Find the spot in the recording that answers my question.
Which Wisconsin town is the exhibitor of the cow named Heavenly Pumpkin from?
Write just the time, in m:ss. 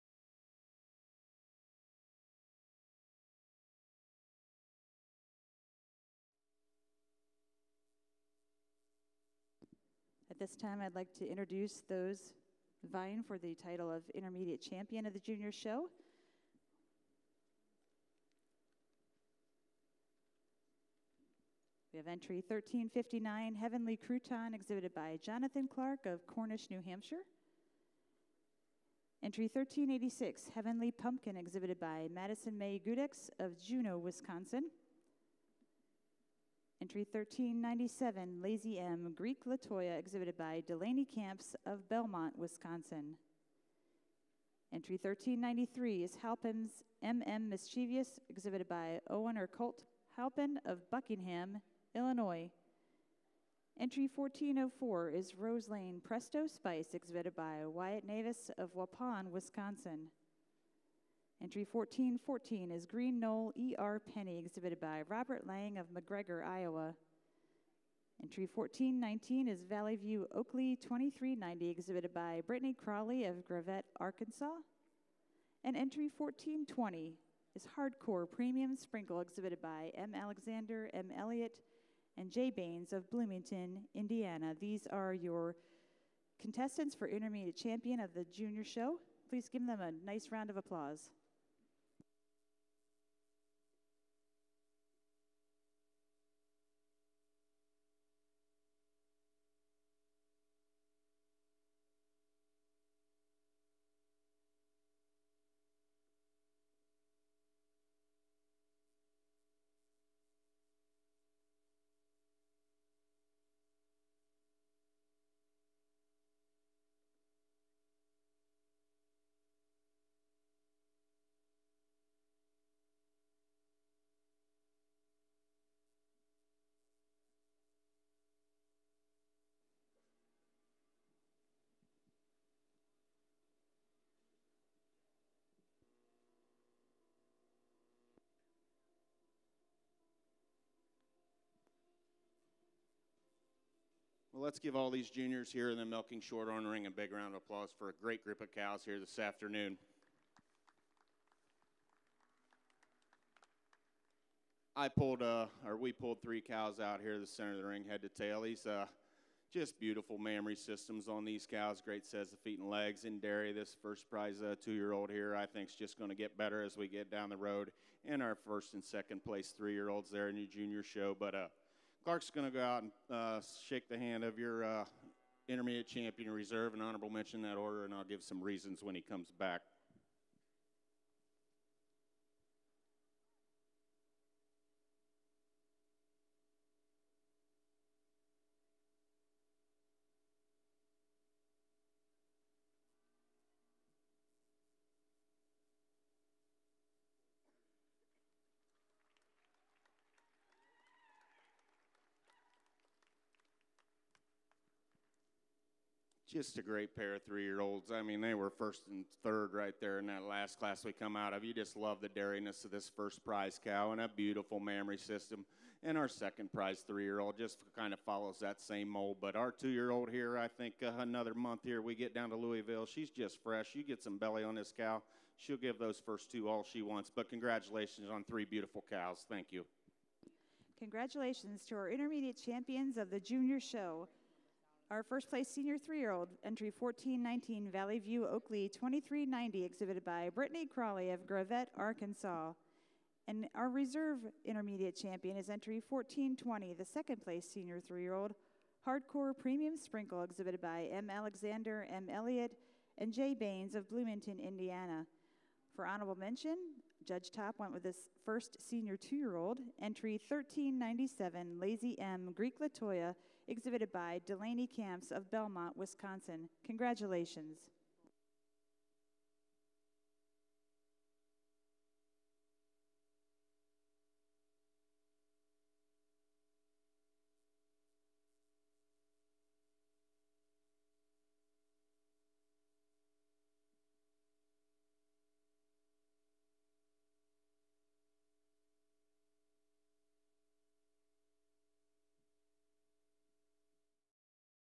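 0:33.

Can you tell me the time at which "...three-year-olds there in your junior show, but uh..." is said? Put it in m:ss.
2:49.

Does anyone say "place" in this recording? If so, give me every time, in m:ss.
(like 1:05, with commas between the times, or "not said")
2:49, 3:55, 4:07.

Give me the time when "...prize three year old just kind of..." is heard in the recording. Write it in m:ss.
3:36.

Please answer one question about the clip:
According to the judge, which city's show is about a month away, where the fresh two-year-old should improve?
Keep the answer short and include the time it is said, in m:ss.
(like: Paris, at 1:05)
Louisville, at 3:42.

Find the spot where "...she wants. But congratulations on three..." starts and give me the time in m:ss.
3:46.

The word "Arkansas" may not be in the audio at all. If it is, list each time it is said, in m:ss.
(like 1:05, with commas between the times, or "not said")
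1:13, 4:01.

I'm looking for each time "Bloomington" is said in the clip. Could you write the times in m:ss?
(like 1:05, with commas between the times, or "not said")
1:23, 4:13.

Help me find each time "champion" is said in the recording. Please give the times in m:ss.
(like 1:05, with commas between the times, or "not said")
0:14, 1:27, 2:55, 3:52, 4:04.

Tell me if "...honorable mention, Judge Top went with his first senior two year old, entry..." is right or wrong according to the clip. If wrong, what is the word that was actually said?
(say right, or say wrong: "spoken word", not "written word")
right.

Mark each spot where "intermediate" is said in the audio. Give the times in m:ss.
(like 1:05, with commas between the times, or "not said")
0:14, 1:27, 2:55, 3:51, 4:04.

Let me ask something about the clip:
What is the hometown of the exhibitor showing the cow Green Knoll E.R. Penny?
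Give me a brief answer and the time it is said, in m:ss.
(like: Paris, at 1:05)
McGregor, Iowa, at 1:05.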